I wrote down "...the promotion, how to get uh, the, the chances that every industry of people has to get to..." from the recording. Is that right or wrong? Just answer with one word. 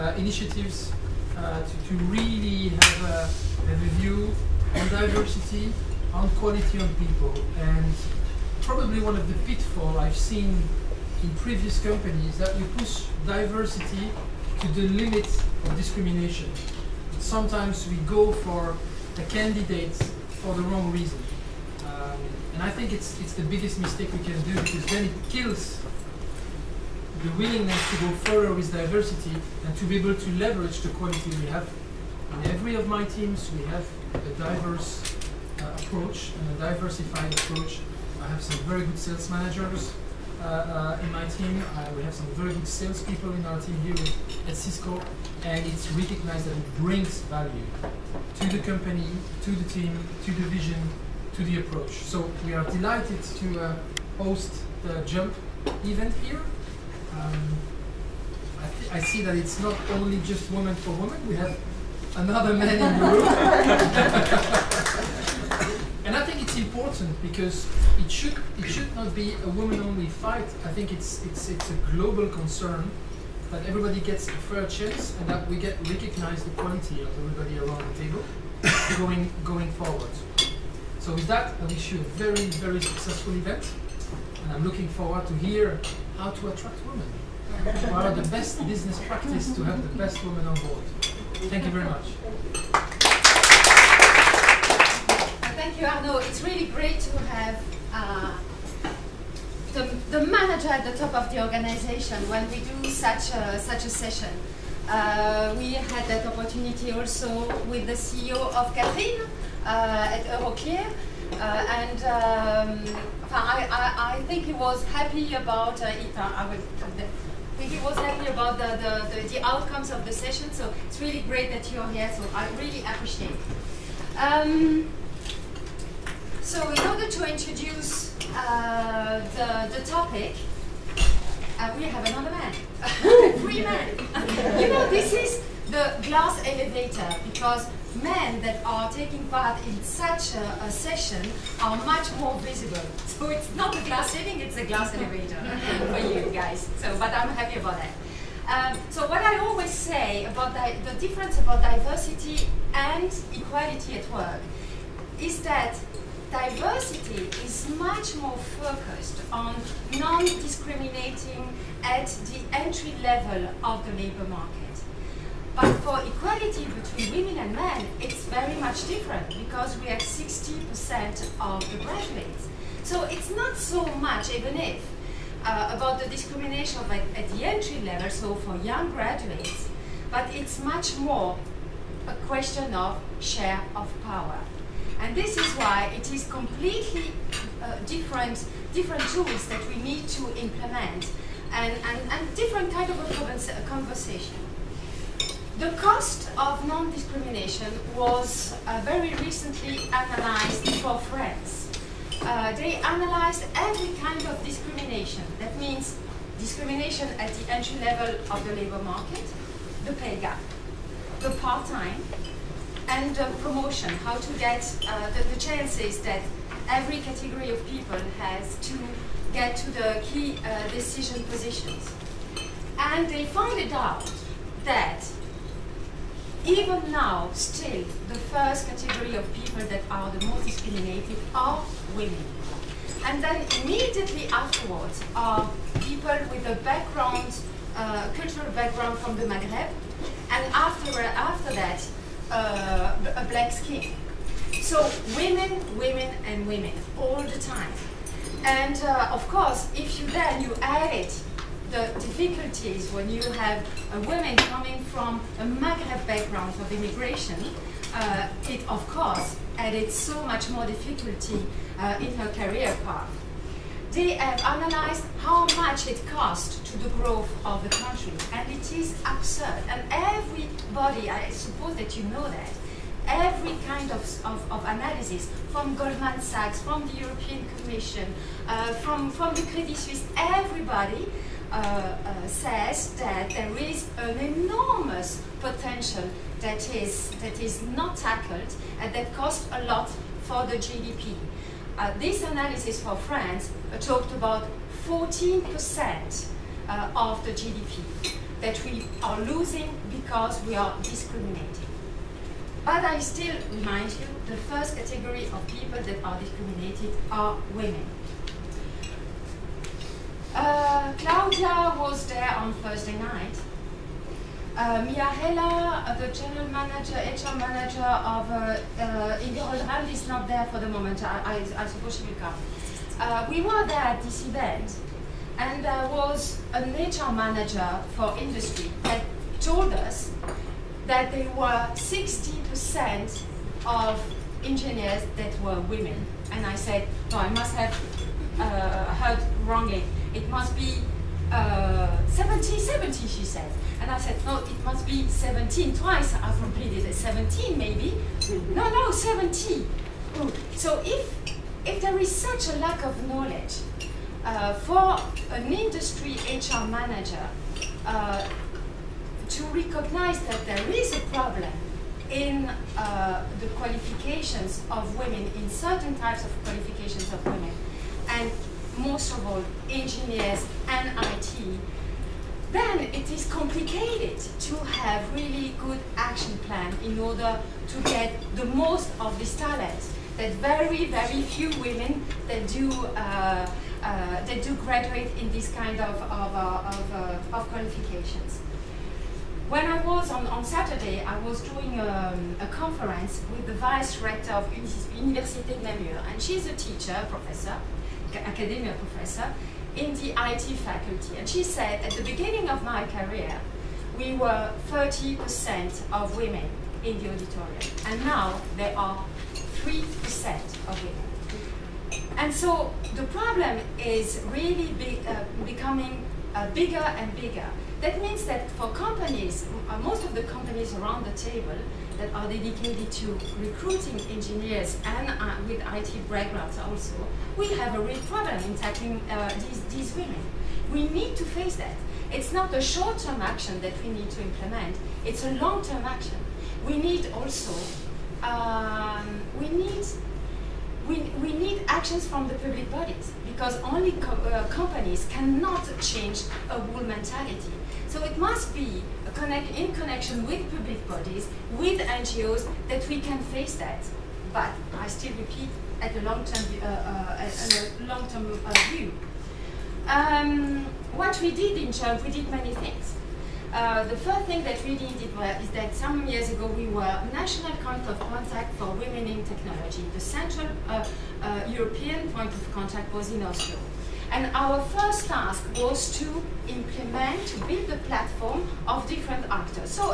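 wrong.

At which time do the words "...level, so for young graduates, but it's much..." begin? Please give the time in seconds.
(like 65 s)
177 s.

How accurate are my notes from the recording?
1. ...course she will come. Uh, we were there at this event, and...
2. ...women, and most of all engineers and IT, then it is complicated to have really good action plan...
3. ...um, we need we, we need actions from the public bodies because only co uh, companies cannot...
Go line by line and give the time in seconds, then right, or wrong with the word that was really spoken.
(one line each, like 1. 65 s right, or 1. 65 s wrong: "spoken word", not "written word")
1. 321 s wrong: "suppose", not "course"
2. 367 s right
3. 438 s right.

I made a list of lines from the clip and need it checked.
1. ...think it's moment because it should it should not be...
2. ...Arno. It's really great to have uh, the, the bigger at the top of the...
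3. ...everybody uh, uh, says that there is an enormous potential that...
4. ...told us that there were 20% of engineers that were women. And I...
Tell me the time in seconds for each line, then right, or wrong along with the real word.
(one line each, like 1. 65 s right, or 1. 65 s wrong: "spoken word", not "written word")
1. 66 s wrong: "important", not "moment"
2. 95 s wrong: "manager", not "bigger"
3. 280 s right
4. 329 s wrong: "60", not "20".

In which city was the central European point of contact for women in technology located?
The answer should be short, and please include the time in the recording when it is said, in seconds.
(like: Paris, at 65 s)
Oslo, at 473 s.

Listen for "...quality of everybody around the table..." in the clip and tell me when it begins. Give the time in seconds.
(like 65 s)
76 s.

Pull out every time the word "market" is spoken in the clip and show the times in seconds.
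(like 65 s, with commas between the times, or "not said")
164 s, 208 s.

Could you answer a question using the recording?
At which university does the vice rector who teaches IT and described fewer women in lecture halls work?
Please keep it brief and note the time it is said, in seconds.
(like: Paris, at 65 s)
Université Namur, at 394 s.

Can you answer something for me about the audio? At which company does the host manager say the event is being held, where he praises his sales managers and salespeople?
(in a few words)
Cisco.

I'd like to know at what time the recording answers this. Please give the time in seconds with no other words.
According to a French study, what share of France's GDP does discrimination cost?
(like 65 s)
294 s.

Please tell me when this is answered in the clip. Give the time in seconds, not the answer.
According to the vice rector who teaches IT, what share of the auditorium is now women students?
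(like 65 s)
409 s.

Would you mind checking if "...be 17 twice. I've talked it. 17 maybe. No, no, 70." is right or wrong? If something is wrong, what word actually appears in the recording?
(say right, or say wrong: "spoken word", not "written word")
wrong: "completed", not "talked".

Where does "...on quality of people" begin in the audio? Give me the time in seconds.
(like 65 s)
6 s.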